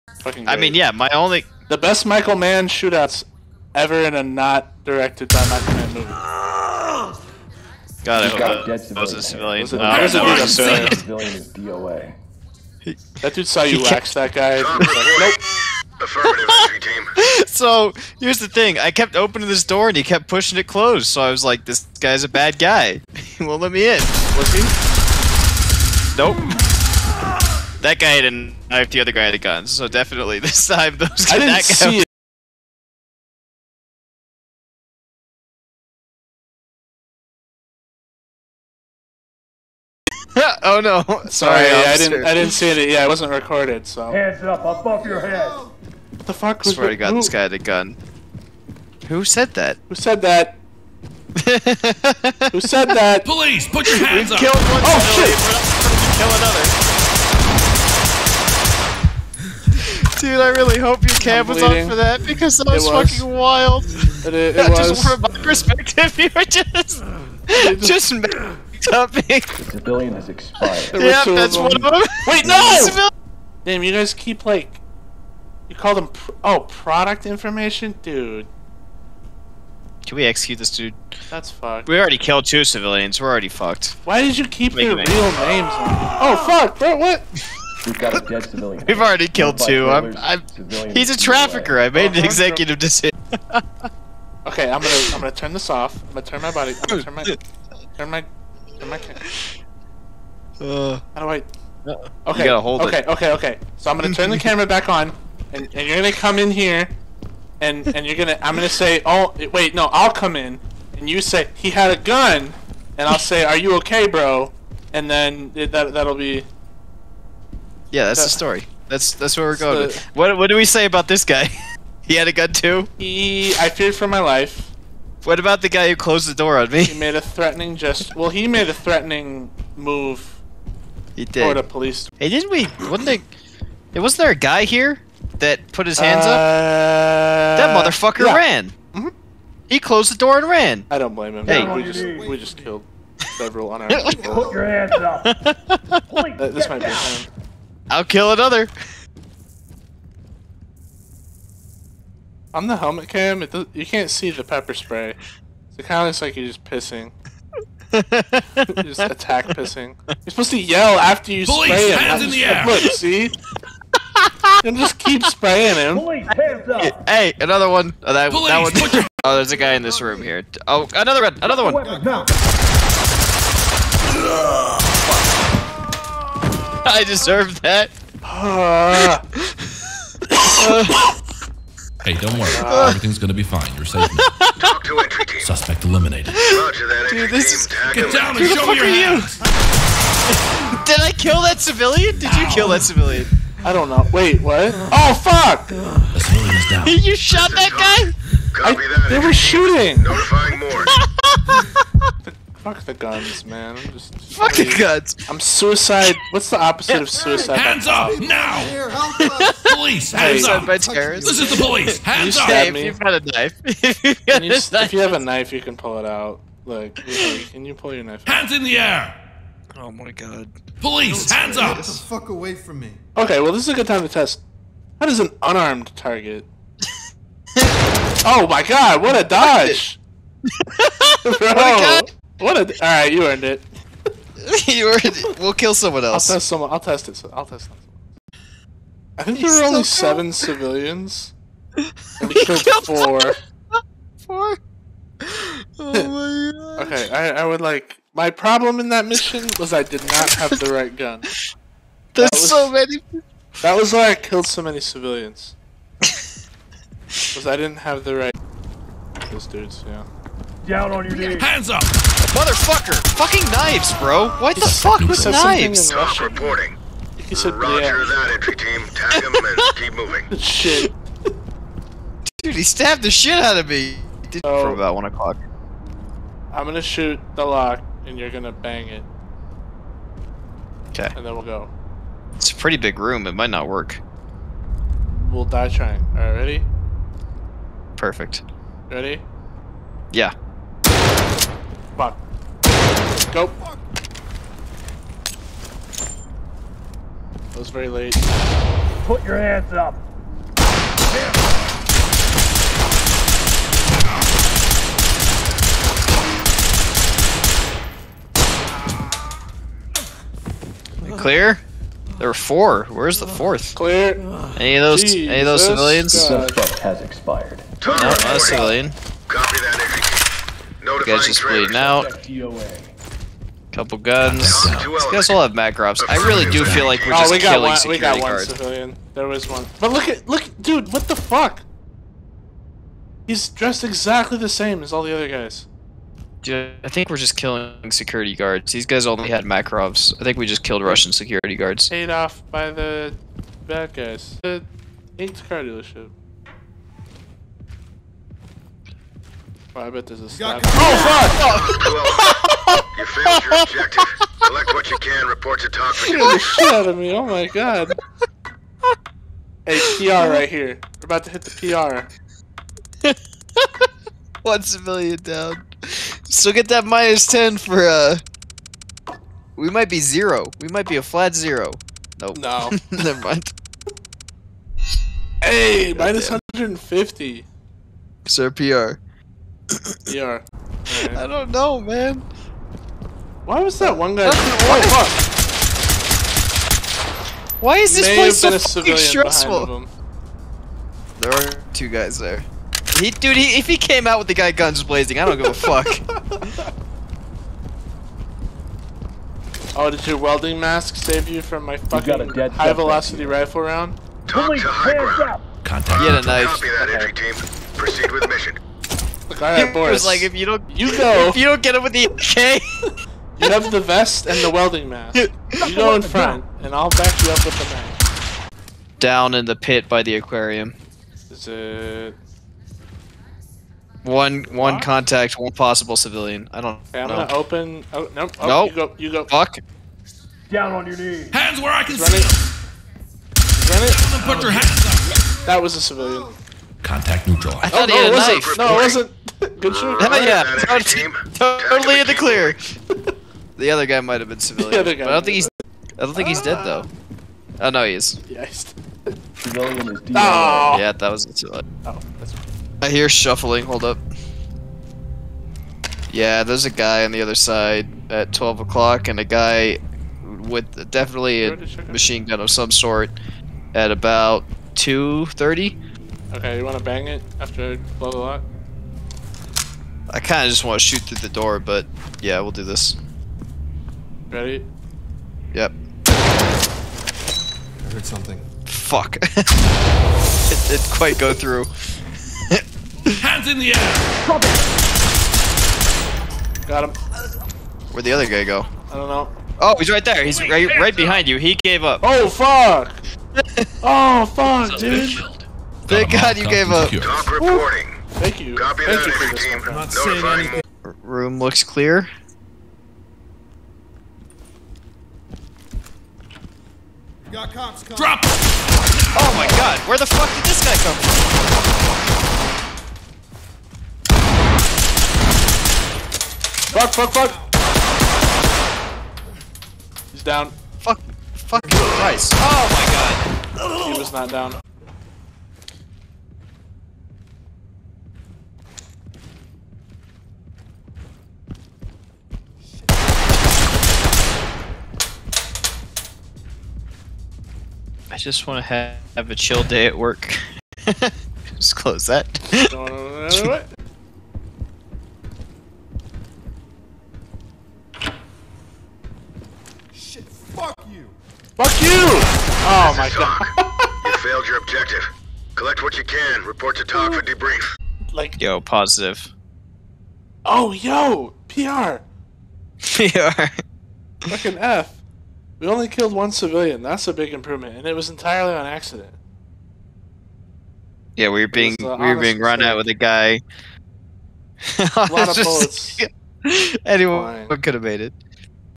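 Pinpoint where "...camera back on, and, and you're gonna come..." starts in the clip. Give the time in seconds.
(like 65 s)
104 s.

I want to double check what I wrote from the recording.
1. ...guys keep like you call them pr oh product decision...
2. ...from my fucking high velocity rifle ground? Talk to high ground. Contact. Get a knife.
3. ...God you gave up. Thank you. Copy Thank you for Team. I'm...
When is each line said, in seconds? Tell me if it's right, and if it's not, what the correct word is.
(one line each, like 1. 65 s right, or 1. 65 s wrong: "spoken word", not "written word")
1. 73 s wrong: "information", not "decision"
2. 401 s wrong: "round", not "ground"
3. 496 s right.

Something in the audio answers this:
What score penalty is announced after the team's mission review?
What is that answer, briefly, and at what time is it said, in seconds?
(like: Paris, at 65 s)
minus 150, at 375 s.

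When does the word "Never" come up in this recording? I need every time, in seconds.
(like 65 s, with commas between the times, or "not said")
372 s.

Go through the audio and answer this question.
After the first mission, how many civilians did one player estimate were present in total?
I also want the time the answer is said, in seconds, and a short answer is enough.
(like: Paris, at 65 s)
7, at 239 s.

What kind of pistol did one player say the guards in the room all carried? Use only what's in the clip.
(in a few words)
Makarovs.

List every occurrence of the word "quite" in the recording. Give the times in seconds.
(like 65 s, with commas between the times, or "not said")
480 s.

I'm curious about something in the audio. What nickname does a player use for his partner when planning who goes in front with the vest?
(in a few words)
Boris.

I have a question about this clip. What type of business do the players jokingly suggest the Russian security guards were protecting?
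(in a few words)
car dealership.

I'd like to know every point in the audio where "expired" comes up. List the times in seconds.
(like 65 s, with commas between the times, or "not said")
70 s, 317 s.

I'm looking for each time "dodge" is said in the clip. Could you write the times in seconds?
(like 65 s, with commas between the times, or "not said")
229 s.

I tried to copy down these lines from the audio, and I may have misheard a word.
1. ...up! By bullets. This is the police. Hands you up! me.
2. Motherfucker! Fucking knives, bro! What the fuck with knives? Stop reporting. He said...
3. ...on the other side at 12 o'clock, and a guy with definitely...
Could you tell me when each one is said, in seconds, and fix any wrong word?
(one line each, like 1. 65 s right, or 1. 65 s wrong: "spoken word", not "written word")
1. 210 s wrong: "terrorists", not "bullets"
2. 261 s right
3. 457 s right.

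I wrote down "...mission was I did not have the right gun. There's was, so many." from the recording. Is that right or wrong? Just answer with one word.
right.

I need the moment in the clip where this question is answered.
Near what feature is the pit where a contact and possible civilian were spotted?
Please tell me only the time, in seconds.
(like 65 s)
420 s.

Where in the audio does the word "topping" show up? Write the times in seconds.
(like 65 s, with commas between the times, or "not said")
68 s.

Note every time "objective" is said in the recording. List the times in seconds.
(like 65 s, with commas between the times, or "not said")
353 s, 554 s.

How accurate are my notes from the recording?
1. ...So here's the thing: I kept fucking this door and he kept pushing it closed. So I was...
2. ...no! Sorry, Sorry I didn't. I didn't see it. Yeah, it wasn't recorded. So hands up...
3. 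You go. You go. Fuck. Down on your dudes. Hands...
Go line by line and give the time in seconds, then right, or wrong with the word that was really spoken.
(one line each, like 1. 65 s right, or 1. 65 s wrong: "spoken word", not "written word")
1. 17 s wrong: "opening", not "fucking"
2. 40 s right
3. 428 s wrong: "knees", not "dudes".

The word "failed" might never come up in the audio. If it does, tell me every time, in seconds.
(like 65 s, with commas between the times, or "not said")
353 s, 554 s.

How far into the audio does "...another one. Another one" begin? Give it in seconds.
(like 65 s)
170 s.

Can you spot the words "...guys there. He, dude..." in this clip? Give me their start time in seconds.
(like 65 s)
391 s.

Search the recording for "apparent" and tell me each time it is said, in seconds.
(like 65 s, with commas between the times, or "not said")
not said.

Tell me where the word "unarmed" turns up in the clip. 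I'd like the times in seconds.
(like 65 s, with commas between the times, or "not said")
143 s, 225 s.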